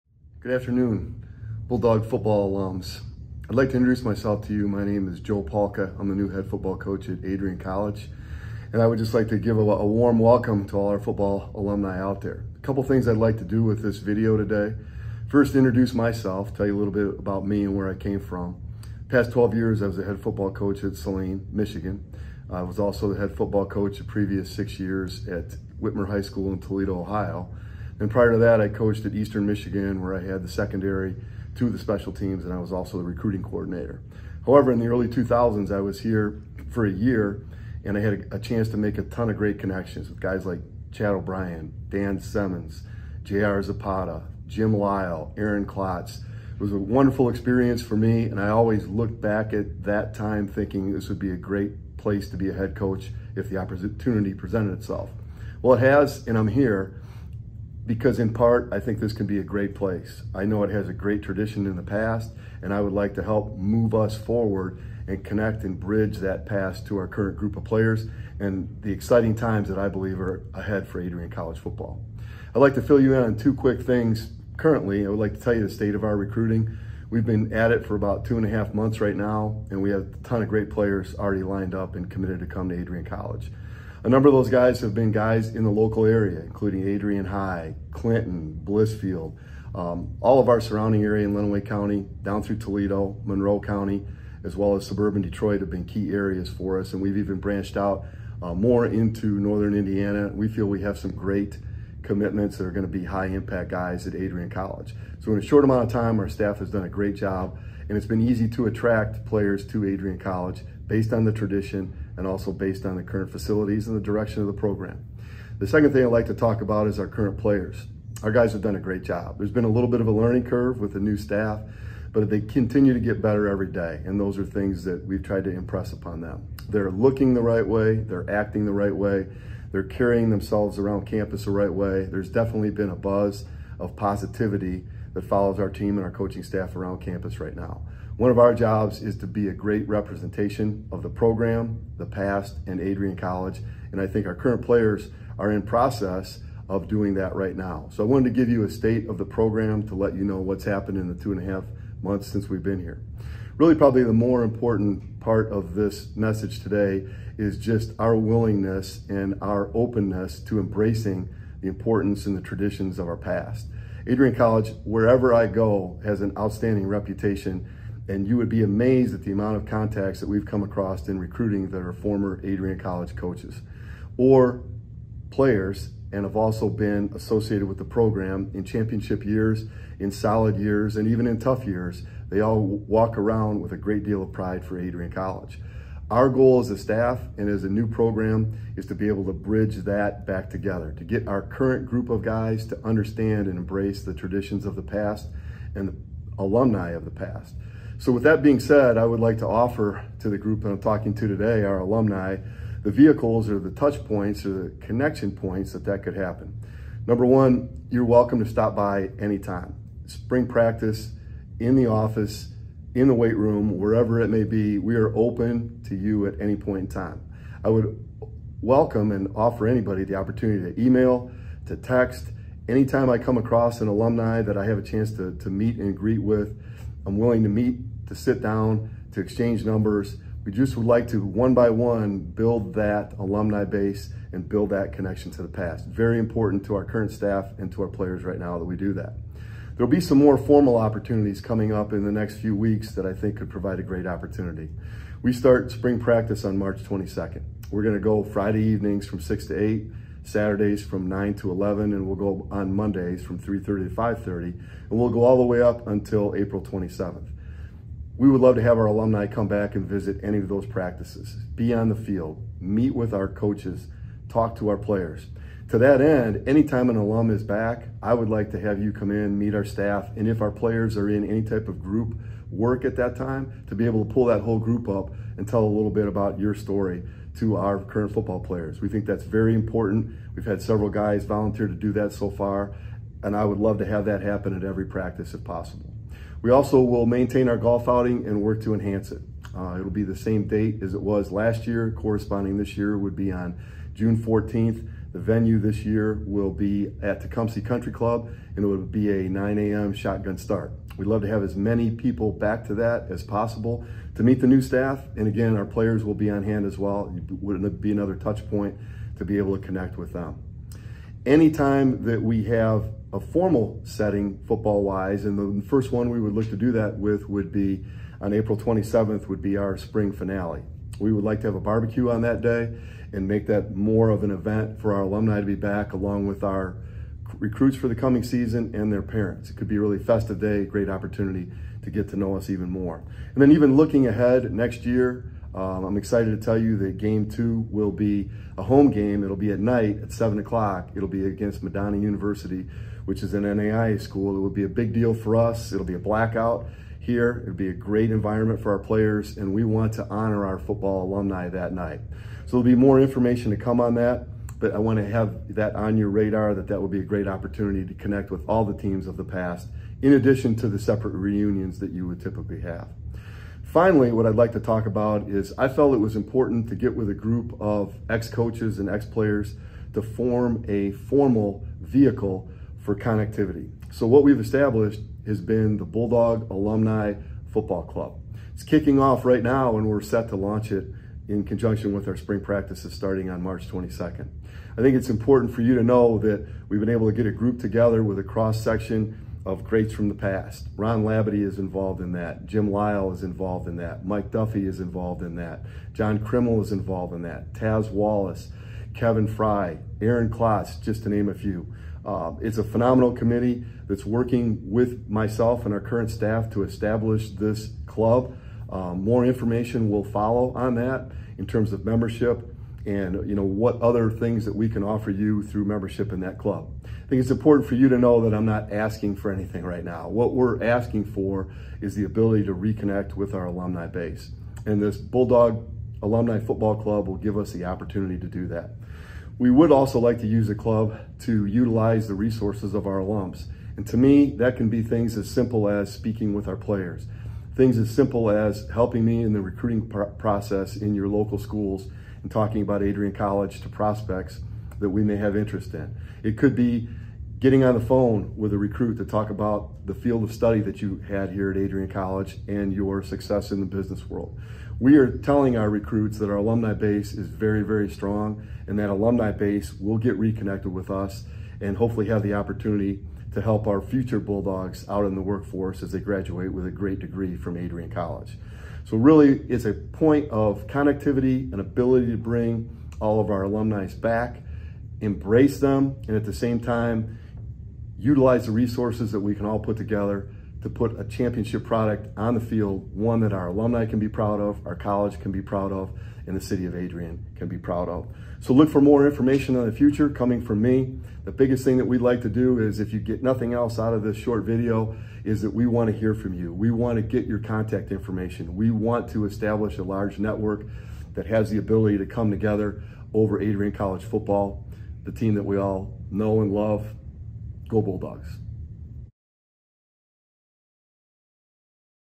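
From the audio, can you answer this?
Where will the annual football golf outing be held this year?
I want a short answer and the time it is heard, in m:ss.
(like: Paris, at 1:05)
Tecumseh Country Club, at 4:57.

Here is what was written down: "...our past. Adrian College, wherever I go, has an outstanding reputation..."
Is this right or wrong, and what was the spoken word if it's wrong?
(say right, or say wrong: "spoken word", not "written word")
right.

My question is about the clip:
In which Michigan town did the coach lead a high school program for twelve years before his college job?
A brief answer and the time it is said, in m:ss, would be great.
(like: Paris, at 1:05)
Saline, at 0:20.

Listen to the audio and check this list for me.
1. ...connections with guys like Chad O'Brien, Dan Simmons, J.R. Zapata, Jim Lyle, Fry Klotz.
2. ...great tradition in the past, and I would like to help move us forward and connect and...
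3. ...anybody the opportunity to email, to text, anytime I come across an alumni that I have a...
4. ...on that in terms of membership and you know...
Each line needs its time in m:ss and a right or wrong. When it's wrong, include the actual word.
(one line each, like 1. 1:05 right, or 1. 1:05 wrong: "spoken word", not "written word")
1. 0:39 wrong: "Aaron", not "Fry"
2. 1:00 right
3. 3:39 right
4. 6:50 right.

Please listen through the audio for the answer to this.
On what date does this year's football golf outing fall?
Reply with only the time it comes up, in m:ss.
4:53.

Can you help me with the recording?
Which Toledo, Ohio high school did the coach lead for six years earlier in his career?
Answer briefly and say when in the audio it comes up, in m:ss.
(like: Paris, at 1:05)
Whitmer High School, at 0:25.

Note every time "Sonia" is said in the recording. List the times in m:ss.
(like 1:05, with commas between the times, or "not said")
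not said.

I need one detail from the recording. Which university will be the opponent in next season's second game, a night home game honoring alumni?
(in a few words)
Madonna University.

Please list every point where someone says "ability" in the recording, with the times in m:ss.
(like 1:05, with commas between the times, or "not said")
7:02, 7:51, 8:21.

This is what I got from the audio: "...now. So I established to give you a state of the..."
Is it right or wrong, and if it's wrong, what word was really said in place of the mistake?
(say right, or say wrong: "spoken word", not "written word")
wrong: "wanted", not "established".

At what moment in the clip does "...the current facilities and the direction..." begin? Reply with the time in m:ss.
1:52.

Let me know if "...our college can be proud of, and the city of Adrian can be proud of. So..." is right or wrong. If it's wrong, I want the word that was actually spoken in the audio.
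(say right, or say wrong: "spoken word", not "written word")
right.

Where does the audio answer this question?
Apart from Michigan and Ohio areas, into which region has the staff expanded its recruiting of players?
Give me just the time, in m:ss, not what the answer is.
1:39.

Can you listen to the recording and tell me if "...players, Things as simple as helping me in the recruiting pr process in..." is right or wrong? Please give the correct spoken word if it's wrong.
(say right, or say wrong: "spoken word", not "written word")
right.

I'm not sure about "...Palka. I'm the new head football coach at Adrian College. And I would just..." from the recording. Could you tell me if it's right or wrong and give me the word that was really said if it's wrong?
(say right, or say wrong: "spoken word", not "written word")
right.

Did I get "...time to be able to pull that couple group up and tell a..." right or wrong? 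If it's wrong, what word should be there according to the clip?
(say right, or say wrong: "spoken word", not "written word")
wrong: "whole", not "couple".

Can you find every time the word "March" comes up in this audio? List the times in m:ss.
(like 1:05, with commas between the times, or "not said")
4:06, 6:23.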